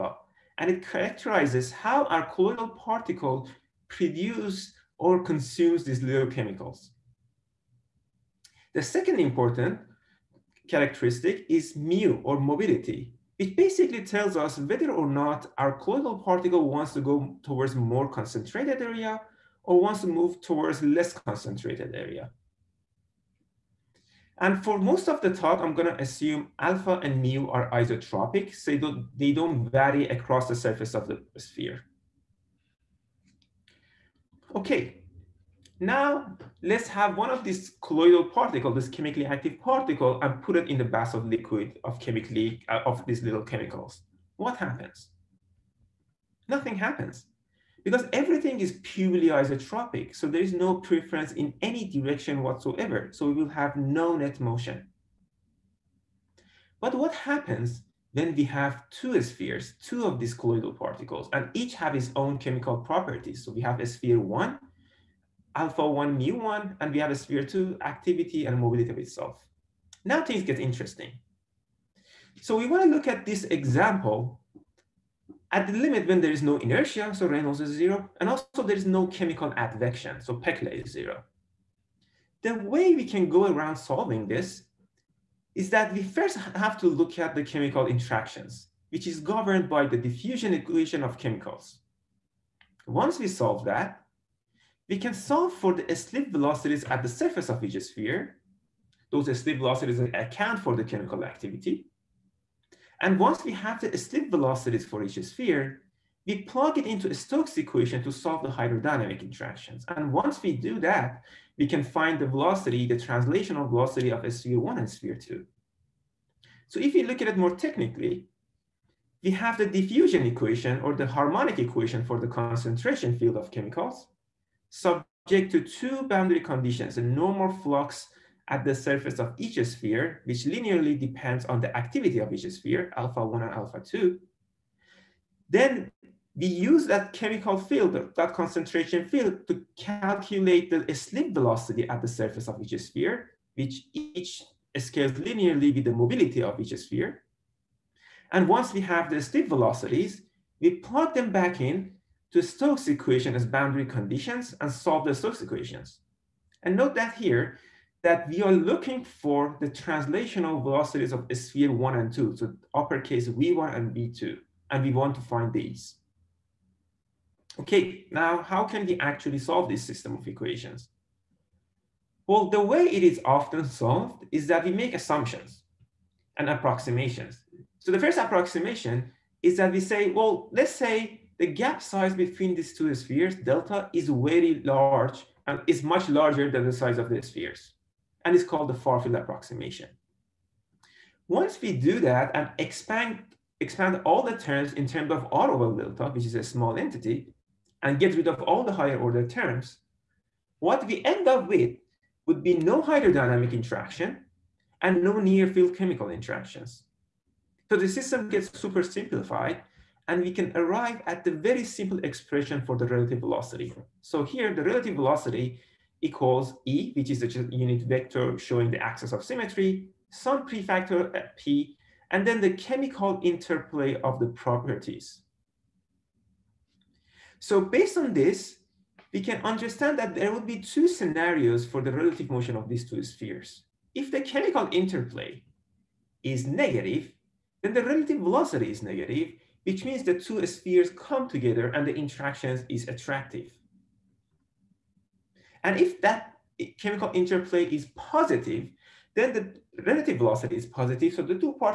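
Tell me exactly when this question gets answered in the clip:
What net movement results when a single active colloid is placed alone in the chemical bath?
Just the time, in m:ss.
0:53.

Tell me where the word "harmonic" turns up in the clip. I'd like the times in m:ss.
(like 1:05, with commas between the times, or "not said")
2:01.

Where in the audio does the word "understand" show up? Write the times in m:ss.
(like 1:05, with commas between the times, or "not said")
3:49.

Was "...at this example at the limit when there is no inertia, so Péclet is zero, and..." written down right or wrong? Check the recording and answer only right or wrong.
wrong.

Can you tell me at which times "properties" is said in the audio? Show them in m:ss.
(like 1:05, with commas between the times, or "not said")
1:02, 3:44.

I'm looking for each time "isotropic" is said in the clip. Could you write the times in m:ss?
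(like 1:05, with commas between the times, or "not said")
0:27, 0:49.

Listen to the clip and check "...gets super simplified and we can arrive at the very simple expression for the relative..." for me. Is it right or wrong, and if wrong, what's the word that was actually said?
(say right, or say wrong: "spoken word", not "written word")
right.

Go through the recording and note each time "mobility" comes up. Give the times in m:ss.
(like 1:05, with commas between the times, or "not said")
0:12, 1:08, 2:25.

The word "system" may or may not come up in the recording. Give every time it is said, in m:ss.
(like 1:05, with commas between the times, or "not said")
2:49, 3:27.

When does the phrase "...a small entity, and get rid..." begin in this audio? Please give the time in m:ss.
3:16.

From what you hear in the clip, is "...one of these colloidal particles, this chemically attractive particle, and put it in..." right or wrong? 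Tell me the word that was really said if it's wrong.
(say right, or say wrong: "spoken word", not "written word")
wrong: "active", not "attractive".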